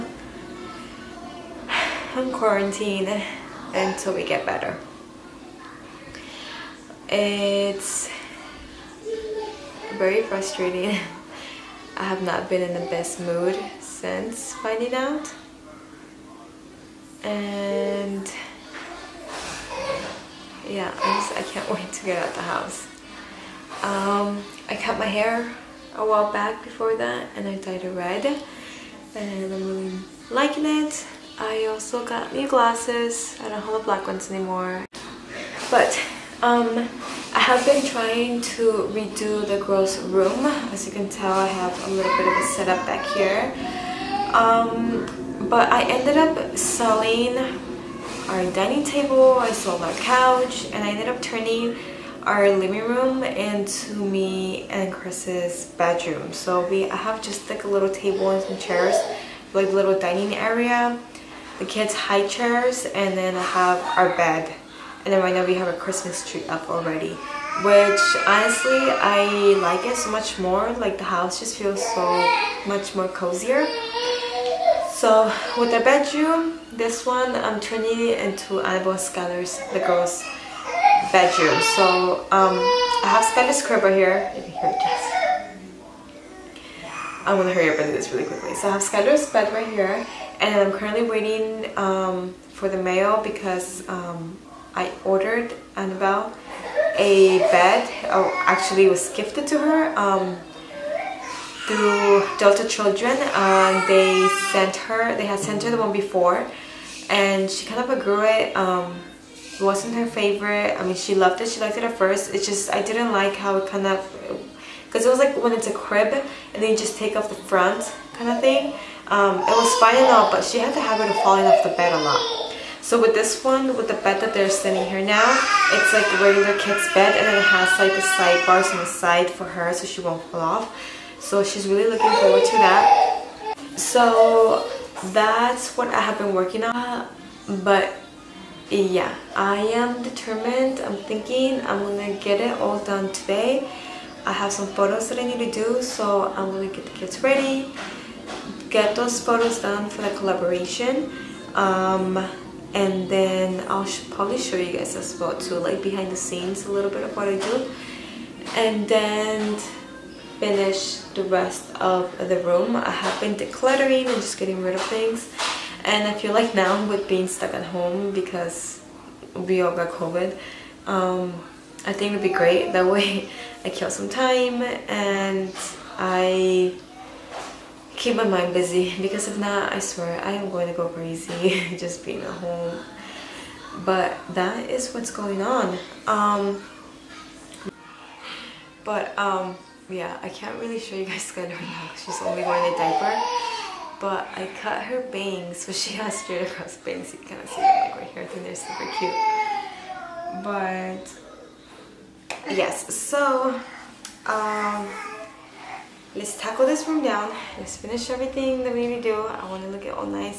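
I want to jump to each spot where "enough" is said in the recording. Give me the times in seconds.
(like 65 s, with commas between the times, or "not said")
120 s.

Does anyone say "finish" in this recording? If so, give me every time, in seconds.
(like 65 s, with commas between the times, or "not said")
160 s, 207 s.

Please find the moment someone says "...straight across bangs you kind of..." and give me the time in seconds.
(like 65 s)
196 s.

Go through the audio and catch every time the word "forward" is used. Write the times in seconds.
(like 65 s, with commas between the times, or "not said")
132 s.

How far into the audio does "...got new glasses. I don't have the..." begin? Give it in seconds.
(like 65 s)
32 s.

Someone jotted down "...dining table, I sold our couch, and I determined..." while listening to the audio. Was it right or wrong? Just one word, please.
wrong.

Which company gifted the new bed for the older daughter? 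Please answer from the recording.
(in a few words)
Delta Children.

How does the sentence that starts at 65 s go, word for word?
And then right now we have a Christmas tree up already, which honestly, I like it so much more.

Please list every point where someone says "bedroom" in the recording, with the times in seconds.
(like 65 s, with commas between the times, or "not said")
55 s, 75 s, 81 s.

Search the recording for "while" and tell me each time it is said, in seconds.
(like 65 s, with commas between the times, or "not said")
26 s.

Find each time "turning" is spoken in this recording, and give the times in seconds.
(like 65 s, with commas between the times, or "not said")
51 s, 77 s.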